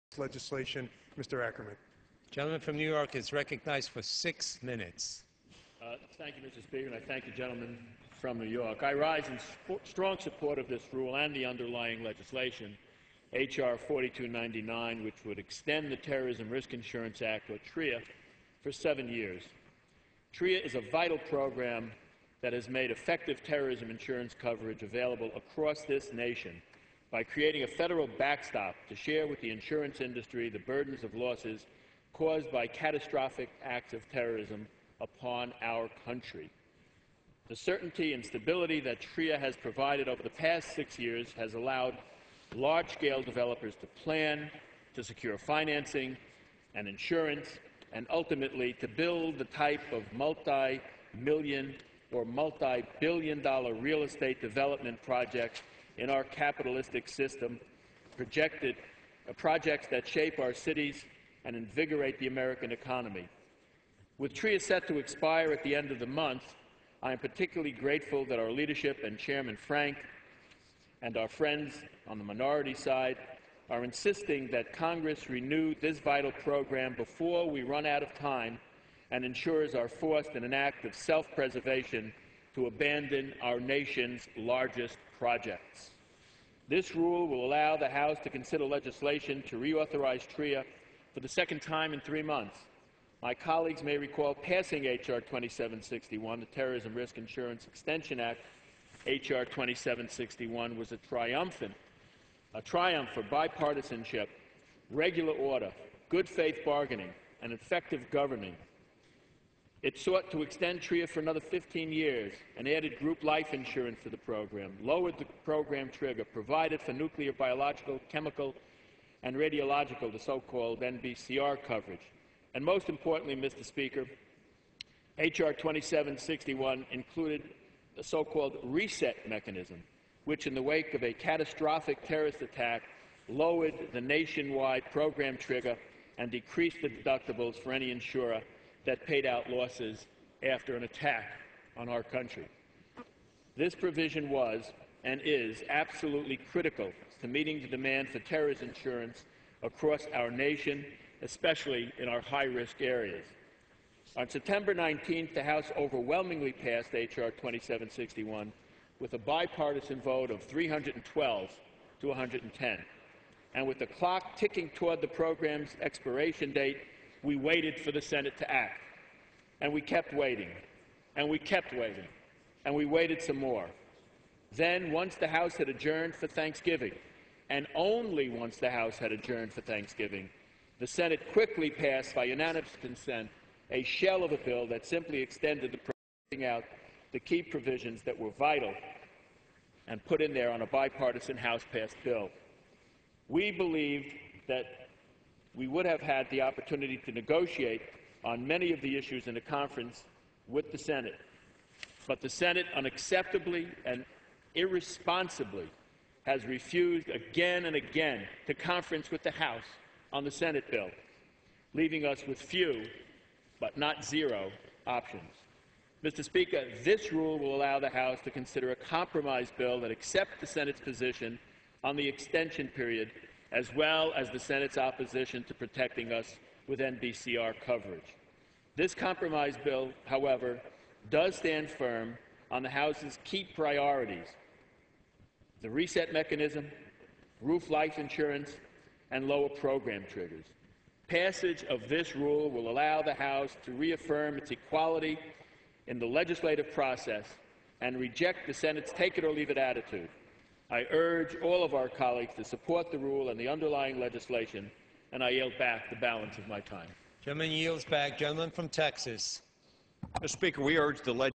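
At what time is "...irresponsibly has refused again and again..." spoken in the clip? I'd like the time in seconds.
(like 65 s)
204 s.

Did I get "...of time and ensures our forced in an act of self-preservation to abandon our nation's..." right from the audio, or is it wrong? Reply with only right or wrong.
right.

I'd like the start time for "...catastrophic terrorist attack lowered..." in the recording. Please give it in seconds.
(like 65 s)
131 s.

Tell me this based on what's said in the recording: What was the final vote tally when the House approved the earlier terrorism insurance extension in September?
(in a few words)
312 to 110.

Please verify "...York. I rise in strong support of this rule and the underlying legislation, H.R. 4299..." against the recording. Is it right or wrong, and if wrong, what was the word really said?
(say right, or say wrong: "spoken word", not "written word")
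right.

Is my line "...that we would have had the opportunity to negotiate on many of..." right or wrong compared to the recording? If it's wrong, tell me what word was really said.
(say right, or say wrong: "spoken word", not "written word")
right.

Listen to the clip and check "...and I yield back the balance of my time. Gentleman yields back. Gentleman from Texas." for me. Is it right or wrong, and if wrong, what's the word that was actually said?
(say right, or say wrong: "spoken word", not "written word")
right.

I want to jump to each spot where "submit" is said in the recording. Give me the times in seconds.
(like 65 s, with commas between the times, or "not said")
not said.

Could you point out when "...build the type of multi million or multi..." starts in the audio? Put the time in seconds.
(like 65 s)
48 s.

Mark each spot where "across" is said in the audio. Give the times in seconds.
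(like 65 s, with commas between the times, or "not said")
25 s, 149 s.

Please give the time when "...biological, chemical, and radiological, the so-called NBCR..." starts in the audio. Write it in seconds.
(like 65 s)
117 s.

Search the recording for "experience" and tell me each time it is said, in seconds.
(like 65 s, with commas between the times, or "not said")
not said.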